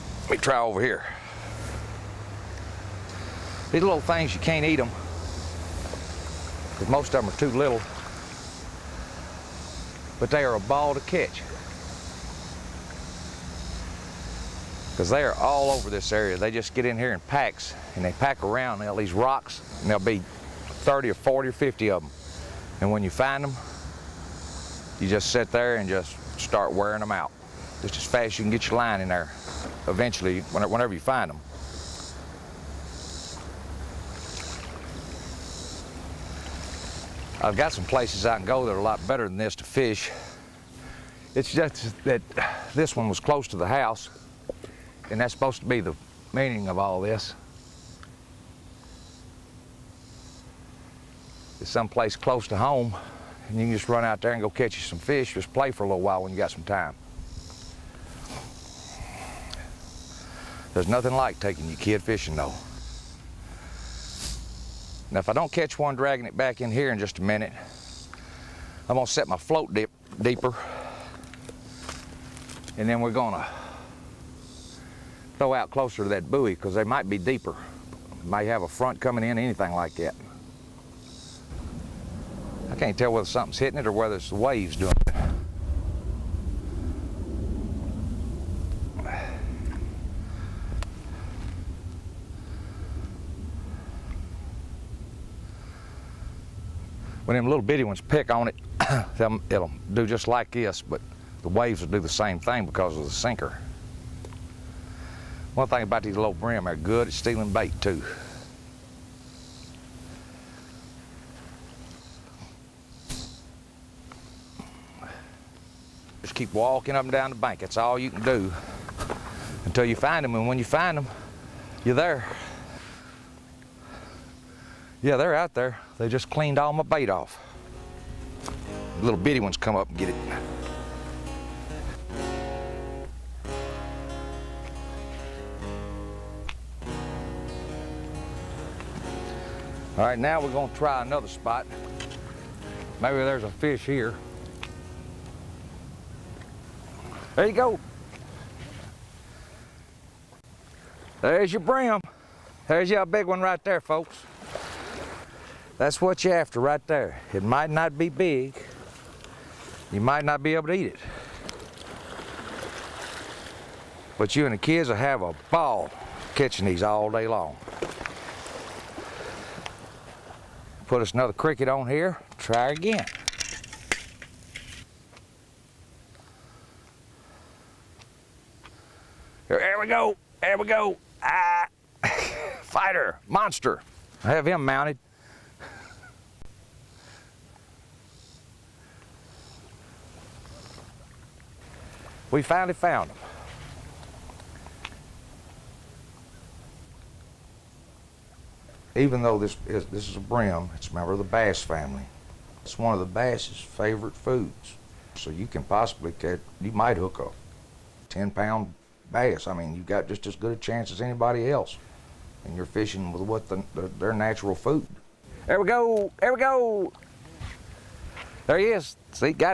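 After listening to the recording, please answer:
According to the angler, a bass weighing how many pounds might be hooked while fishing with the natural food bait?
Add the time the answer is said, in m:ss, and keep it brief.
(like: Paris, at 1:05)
10 pounds, at 3:28.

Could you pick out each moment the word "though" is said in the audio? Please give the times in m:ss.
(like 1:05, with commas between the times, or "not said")
1:02, 3:19.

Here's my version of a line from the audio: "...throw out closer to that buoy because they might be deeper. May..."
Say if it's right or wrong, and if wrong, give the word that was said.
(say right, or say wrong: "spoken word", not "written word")
right.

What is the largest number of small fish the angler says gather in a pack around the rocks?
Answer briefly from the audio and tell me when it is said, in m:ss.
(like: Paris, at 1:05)
50, at 0:21.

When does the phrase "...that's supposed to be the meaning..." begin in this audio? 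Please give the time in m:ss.
0:45.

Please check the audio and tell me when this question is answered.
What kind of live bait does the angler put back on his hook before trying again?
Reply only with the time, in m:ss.
2:51.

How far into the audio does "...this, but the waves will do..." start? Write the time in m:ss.
1:40.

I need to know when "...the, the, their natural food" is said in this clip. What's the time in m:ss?
3:33.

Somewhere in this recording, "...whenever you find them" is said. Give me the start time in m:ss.
0:30.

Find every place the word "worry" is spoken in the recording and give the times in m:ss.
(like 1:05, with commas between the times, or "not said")
not said.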